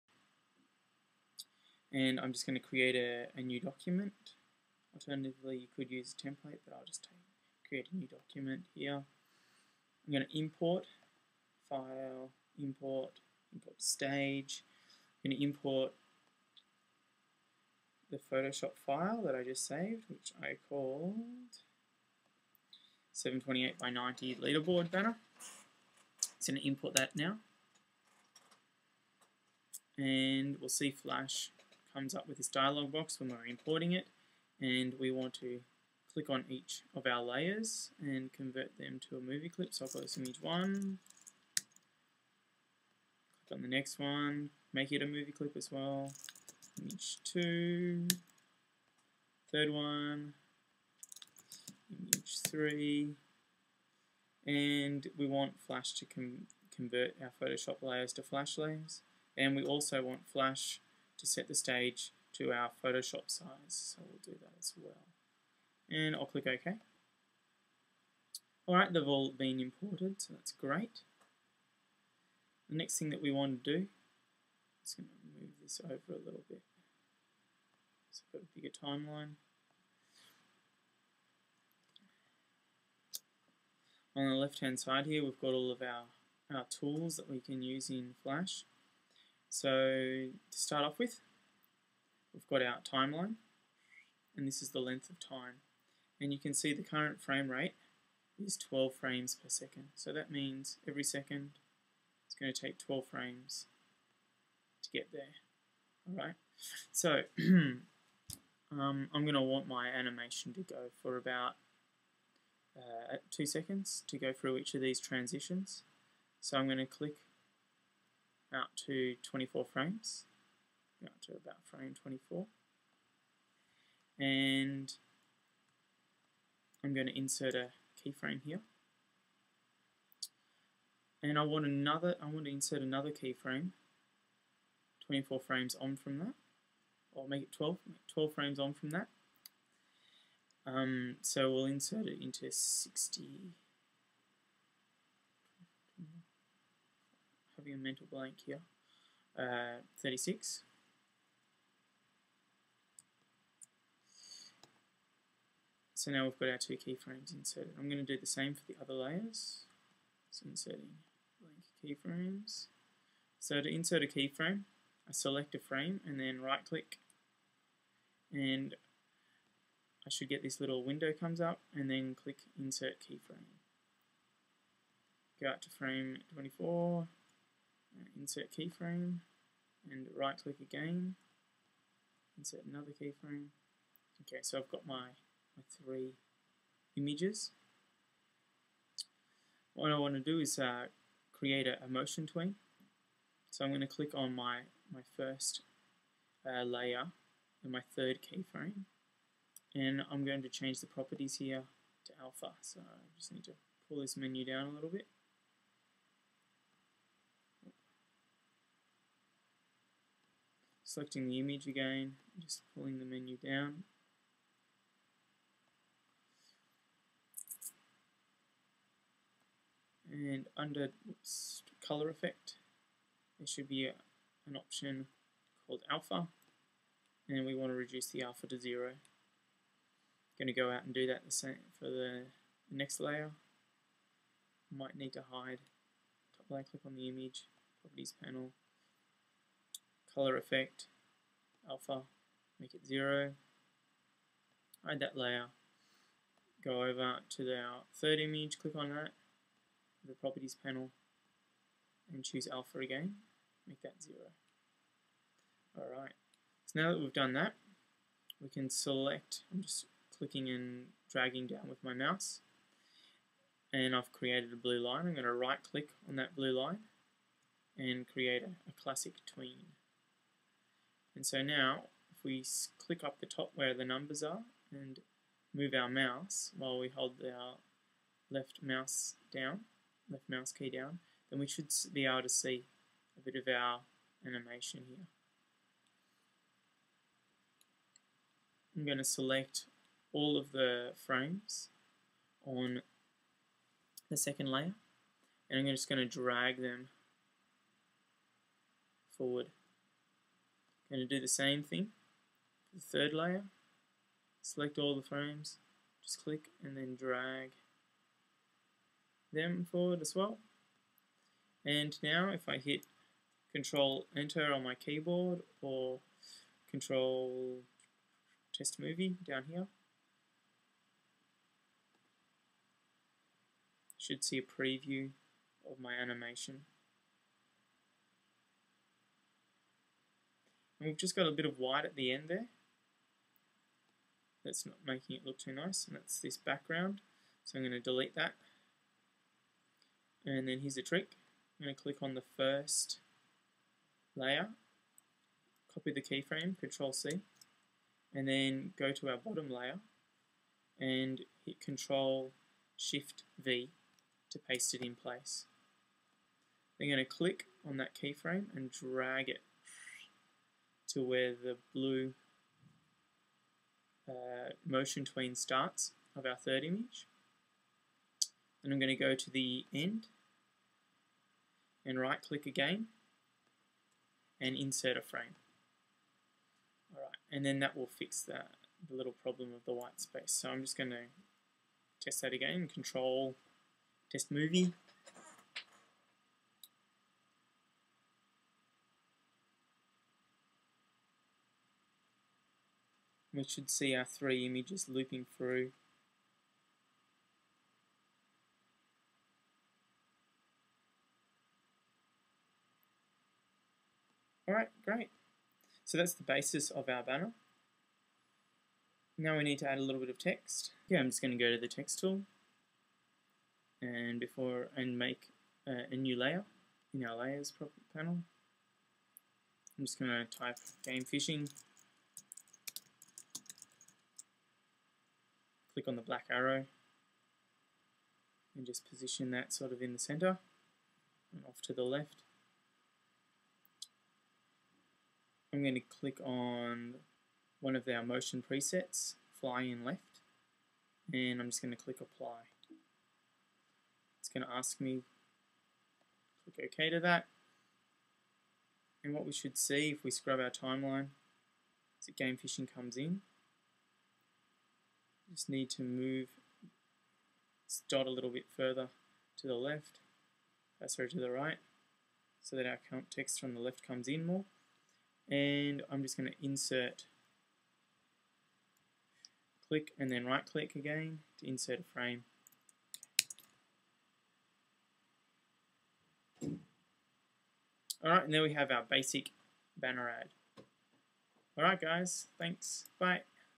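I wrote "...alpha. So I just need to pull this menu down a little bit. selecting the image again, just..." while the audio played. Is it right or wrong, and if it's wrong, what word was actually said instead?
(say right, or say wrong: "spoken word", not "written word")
right.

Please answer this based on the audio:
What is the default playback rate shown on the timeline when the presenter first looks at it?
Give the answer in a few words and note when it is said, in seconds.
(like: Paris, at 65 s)
12 frames per second, at 98 s.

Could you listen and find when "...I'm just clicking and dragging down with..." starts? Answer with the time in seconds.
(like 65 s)
259 s.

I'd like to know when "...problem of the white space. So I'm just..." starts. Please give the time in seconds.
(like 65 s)
379 s.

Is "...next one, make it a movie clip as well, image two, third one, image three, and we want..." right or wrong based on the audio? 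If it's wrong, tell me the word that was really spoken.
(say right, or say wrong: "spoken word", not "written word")
right.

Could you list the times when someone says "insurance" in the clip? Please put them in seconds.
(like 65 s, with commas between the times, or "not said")
not said.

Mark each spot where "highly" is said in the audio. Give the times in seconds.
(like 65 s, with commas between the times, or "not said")
not said.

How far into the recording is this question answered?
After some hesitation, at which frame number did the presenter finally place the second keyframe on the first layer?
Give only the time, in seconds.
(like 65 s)
150 s.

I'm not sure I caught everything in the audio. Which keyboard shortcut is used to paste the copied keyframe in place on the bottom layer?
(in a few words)
Control Shift V.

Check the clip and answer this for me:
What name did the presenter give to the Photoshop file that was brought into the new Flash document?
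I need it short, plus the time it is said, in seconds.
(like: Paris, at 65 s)
728 by 90 leaderboard banner, at 23 s.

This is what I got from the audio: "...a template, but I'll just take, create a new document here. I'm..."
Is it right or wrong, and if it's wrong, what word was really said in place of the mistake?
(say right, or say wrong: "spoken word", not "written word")
right.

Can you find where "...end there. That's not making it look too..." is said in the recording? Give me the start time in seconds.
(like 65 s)
332 s.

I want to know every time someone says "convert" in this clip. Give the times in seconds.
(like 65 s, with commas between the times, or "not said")
38 s, 56 s.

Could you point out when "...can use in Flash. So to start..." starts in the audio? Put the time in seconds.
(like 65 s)
87 s.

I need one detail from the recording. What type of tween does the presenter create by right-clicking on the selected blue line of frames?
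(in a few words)
Classic tween.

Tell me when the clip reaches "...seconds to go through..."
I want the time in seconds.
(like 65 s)
113 s.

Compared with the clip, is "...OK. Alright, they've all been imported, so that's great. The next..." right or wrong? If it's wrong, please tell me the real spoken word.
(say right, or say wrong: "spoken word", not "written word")
right.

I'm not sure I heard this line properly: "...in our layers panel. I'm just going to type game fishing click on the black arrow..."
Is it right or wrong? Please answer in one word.
right.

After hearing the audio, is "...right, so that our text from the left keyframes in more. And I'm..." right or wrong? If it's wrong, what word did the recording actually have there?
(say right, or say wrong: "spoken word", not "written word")
wrong: "comes", not "keyframes".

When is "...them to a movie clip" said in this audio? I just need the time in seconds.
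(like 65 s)
38 s.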